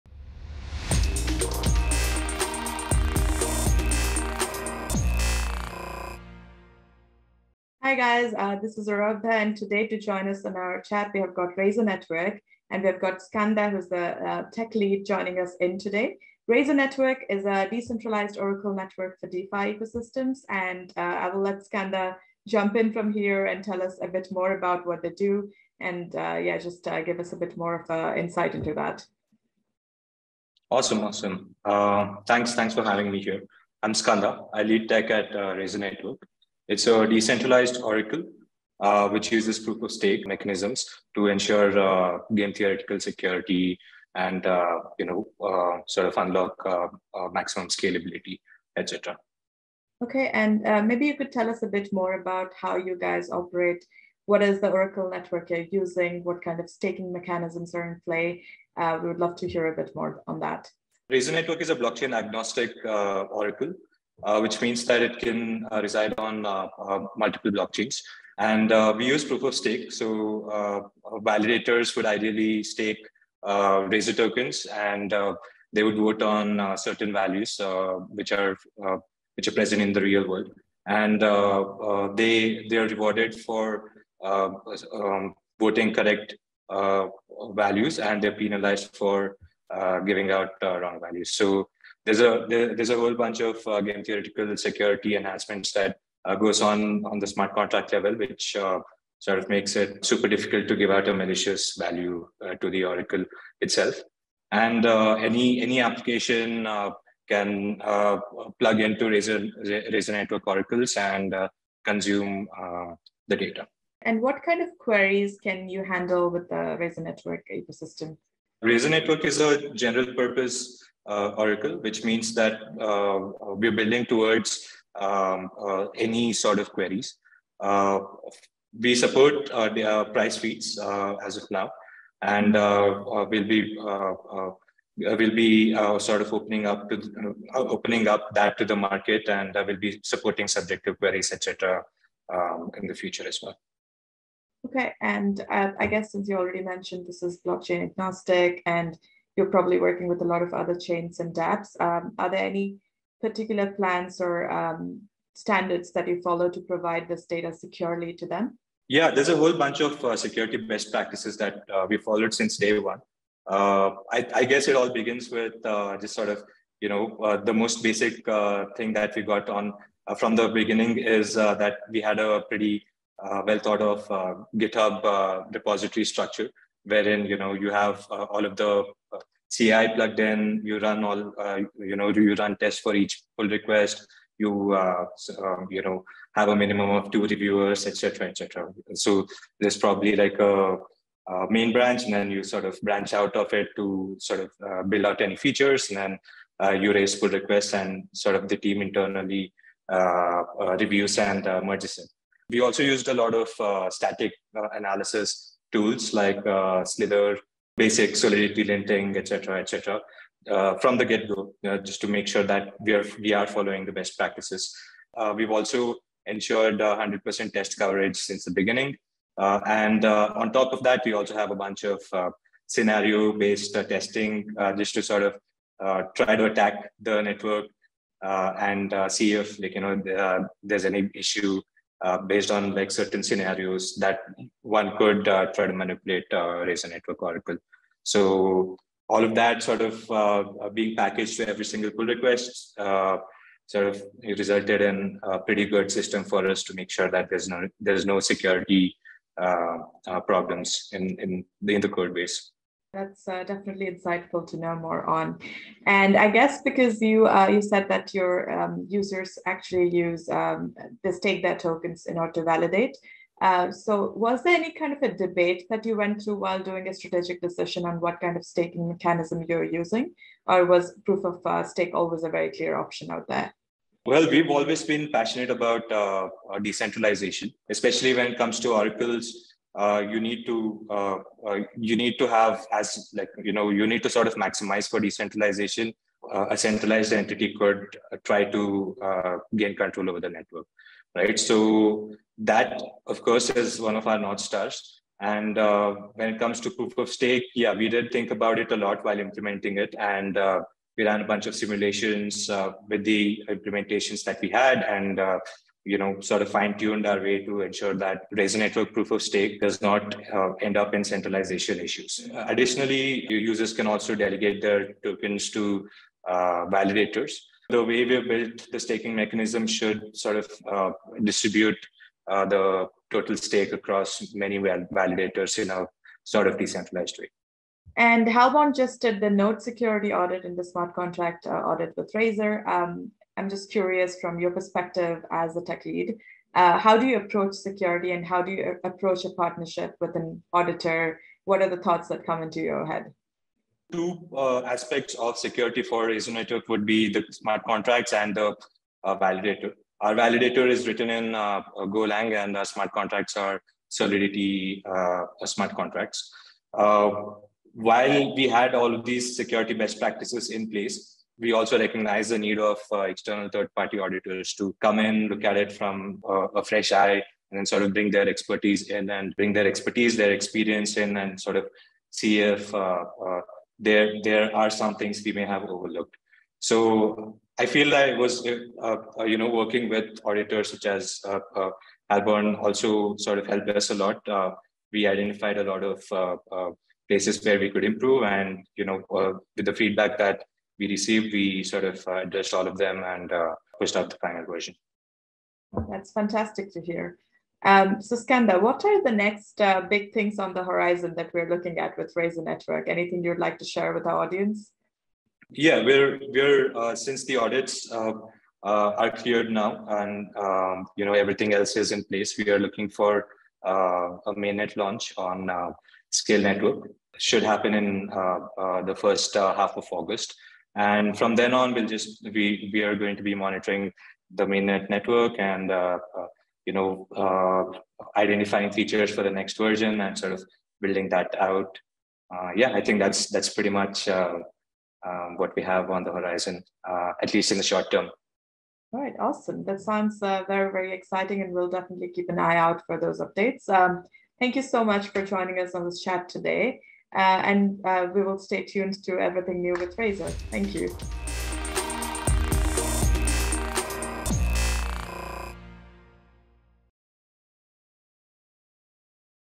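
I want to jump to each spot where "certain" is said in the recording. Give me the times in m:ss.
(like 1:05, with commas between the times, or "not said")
1:16, 3:52.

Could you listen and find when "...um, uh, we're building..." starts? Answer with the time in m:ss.
2:02.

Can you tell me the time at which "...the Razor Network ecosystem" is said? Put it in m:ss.
1:56.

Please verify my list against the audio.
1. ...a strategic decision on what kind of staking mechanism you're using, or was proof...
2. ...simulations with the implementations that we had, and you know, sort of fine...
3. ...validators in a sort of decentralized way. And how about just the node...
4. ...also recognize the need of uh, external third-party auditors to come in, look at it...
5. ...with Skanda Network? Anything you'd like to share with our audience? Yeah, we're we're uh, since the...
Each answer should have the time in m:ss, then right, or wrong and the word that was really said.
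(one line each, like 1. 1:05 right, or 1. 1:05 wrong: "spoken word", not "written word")
1. 4:26 right
2. 5:01 right
3. 5:24 right
4. 6:01 right
5. 6:41 wrong: "Razor", not "Skanda".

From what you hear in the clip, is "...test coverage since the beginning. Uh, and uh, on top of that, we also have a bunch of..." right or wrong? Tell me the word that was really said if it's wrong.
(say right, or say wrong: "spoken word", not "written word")
right.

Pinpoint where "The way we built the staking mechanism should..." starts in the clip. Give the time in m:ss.
5:17.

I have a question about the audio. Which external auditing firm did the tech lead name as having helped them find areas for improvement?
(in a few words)
Halborn.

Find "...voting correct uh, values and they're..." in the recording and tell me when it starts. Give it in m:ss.
1:25.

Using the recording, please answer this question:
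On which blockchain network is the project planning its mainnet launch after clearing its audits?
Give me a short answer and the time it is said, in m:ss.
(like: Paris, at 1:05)
SKALE Network, at 6:56.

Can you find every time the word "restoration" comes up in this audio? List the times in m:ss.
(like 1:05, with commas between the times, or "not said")
not said.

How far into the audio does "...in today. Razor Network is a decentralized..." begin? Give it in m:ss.
0:15.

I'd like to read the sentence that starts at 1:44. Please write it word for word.
And uh, any any application uh, can plug into Razor Razor Network Oracles and consume the data.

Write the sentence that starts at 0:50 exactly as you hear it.
Okay, and maybe you could tell us a bit more about how you guys operate.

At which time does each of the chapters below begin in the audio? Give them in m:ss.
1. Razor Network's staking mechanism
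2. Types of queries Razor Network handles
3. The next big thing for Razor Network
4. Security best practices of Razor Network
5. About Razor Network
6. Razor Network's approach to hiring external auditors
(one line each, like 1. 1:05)
1. 4:25
2. 1:54
3. 6:45
4. 2:39
5. 0:37
6. 5:45.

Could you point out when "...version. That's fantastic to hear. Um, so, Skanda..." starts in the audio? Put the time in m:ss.
6:34.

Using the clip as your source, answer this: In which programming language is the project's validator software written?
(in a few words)
Golang.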